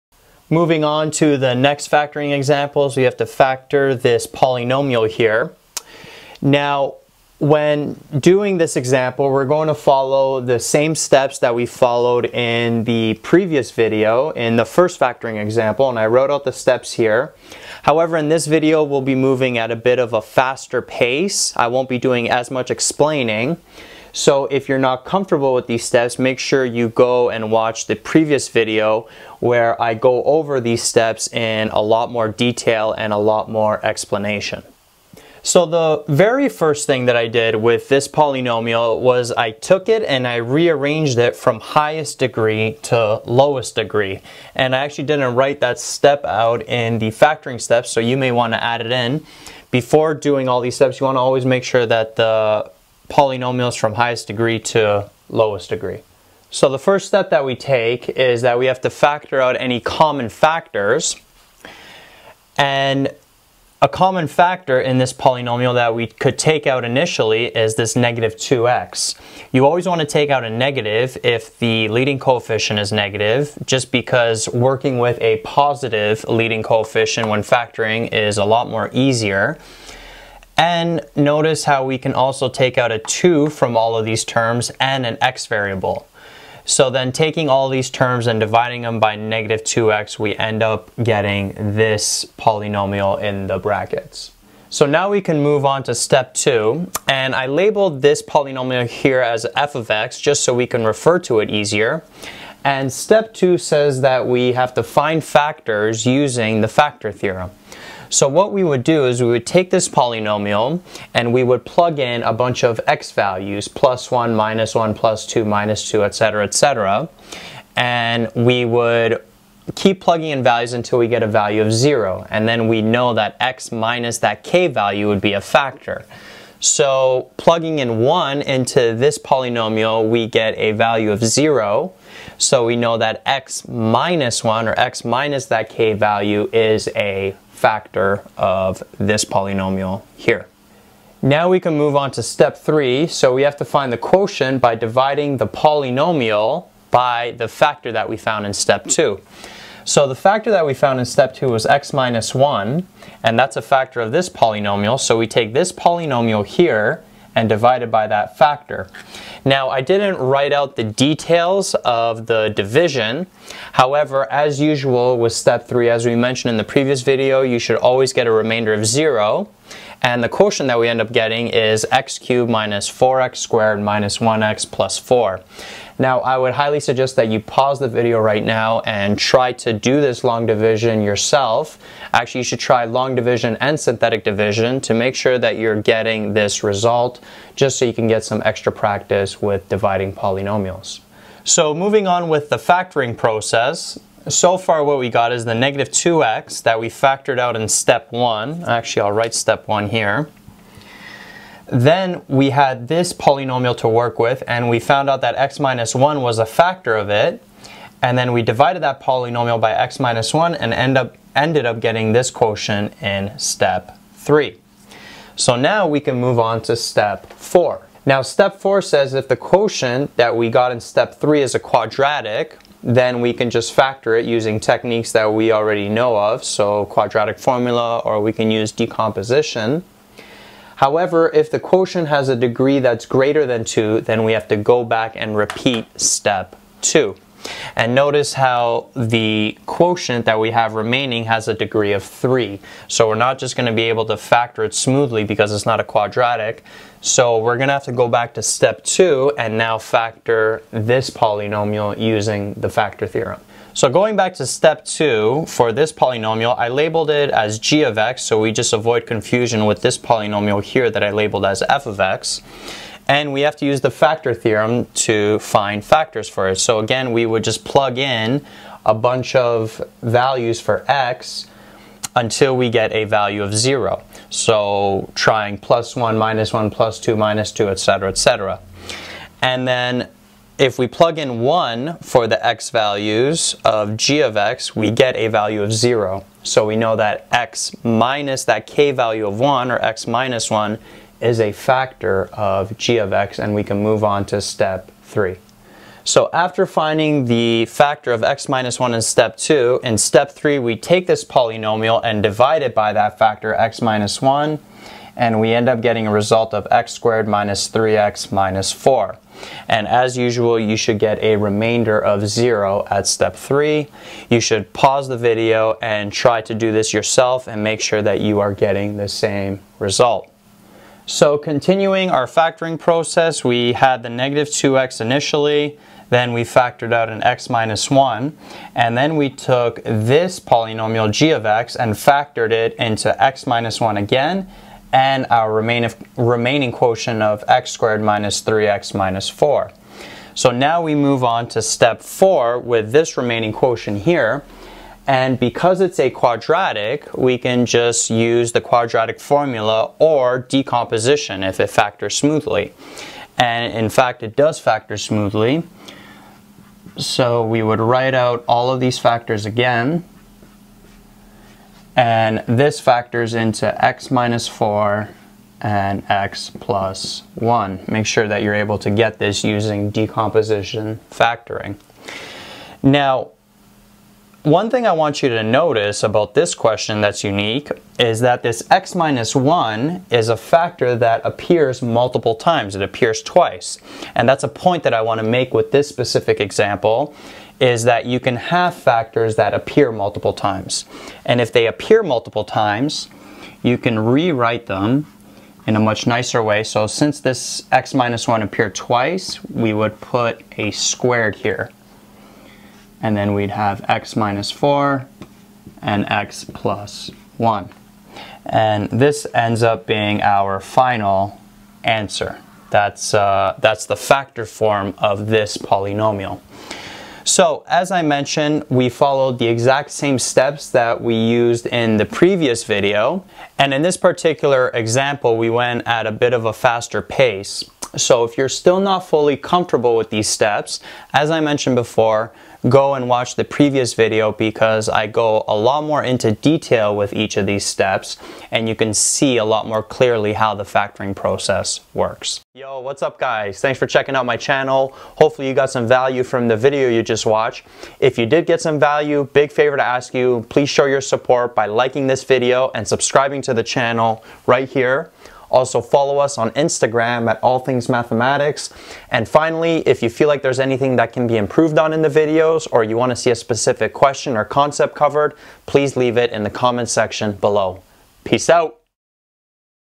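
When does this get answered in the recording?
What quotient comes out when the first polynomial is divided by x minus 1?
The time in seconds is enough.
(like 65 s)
171 s.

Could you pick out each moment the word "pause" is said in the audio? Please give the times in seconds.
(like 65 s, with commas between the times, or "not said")
177 s, 314 s.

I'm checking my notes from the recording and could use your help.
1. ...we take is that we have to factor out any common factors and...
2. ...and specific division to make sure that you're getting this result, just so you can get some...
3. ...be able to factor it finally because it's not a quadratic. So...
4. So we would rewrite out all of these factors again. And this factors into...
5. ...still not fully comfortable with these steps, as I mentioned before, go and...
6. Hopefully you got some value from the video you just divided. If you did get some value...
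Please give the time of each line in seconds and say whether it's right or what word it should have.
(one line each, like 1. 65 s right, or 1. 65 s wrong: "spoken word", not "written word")
1. 57 s right
2. 183 s wrong: "synthetic", not "specific"
3. 243 s wrong: "smoothly", not "finally"
4. 356 s wrong: "write", not "rewrite"
5. 428 s right
6. 445 s wrong: "watched", not "divided".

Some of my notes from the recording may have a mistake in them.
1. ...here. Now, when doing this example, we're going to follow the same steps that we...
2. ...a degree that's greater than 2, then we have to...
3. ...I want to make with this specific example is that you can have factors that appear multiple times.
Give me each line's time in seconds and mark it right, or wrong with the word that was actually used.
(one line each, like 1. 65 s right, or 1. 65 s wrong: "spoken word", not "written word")
1. 5 s right
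2. 232 s right
3. 384 s right.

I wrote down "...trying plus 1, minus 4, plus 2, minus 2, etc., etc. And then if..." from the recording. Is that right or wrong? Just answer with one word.
wrong.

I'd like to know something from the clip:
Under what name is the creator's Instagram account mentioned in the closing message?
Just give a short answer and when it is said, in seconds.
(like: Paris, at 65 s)
All Things Mathematics, at 457 s.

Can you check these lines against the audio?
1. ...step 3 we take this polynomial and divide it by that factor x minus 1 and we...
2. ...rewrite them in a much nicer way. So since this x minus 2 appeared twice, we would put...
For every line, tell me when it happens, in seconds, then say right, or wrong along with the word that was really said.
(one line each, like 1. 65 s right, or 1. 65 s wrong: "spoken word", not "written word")
1. 299 s right
2. 393 s wrong: "1", not "2".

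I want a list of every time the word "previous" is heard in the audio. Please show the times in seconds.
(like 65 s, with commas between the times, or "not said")
13 s, 27 s, 166 s, 422 s, 433 s.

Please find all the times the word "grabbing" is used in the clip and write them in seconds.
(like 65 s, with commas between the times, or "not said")
not said.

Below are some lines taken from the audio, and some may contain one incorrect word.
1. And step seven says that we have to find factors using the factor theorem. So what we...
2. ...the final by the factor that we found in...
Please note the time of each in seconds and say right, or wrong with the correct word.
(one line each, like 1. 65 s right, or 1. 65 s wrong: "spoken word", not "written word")
1. 102 s wrong: "two", not "seven"
2. 145 s wrong: "polynomial", not "final".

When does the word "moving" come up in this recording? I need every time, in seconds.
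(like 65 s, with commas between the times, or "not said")
0 s, 19 s, 191 s.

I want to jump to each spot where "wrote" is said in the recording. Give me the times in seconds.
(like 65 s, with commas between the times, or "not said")
16 s.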